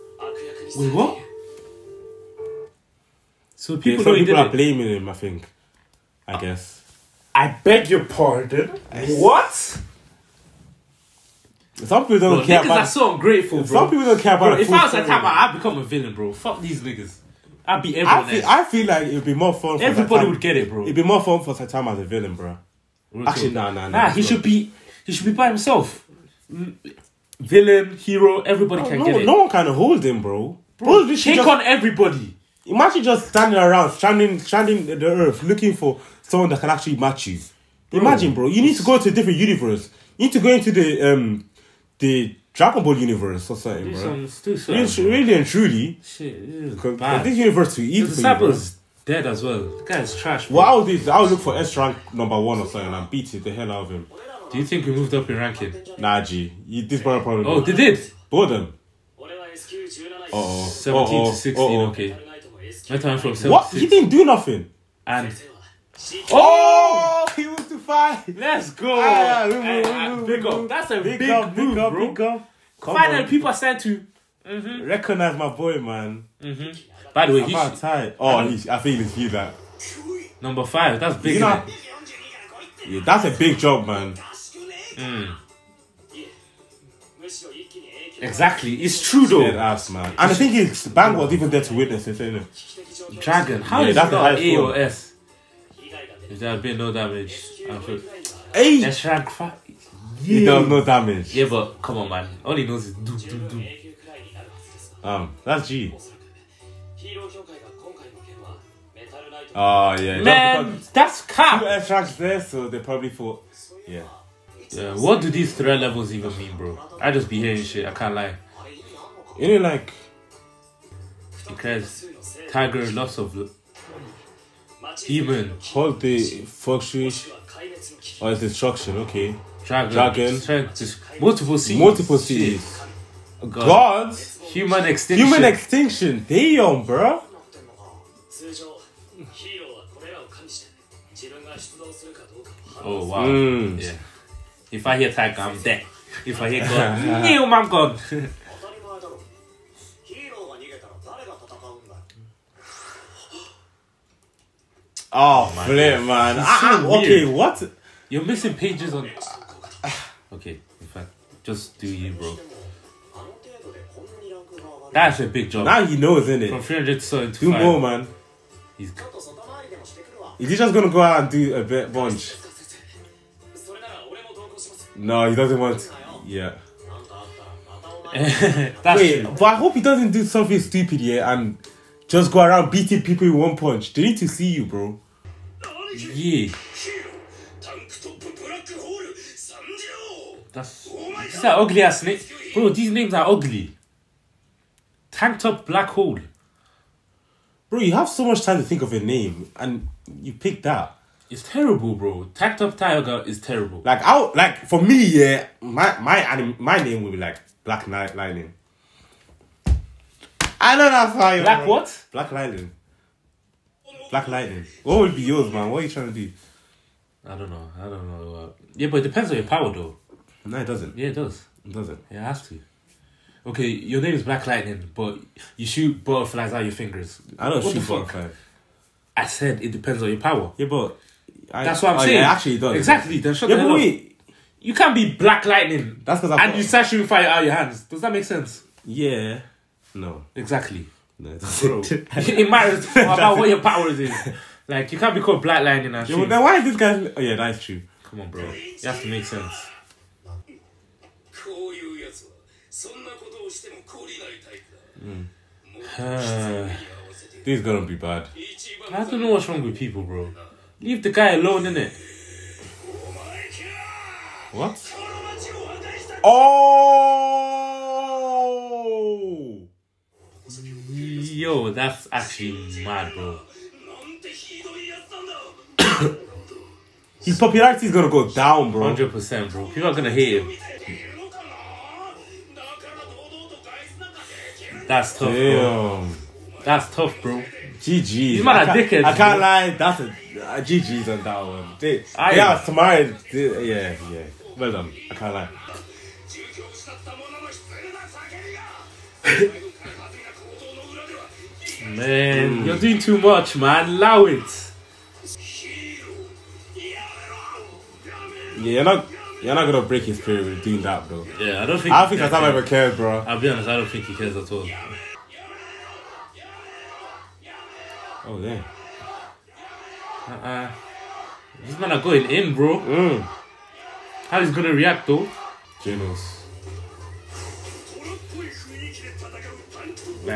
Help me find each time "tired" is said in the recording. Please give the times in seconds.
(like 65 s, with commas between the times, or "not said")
77 s.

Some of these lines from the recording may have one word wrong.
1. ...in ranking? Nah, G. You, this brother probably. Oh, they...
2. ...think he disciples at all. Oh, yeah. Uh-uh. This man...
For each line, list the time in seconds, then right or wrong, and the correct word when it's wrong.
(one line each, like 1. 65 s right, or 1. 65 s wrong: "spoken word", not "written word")
1. 55 s right
2. 313 s wrong: "cares", not "disciples".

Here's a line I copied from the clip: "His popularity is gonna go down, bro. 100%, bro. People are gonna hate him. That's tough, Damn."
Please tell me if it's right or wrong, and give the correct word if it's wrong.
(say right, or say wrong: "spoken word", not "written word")
right.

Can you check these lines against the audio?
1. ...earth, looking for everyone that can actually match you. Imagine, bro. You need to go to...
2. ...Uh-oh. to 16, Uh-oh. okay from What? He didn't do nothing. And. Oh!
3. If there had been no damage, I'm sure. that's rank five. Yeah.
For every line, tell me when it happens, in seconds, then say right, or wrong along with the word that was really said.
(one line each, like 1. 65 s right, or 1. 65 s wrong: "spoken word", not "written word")
1. 35 s wrong: "someone", not "everyone"
2. 61 s right
3. 96 s right.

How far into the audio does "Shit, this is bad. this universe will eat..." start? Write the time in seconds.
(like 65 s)
46 s.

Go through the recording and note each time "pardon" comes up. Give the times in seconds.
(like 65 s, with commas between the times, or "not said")
8 s.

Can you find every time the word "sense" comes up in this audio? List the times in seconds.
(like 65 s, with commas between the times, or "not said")
238 s, 249 s.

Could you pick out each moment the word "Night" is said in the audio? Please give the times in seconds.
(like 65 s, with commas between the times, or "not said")
207 s.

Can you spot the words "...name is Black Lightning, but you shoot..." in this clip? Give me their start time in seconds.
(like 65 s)
223 s.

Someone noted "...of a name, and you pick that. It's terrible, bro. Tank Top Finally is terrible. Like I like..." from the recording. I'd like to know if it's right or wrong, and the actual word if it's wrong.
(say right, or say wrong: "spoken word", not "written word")
wrong: "Tiger", not "Finally".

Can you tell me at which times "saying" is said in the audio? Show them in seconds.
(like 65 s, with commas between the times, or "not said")
232 s.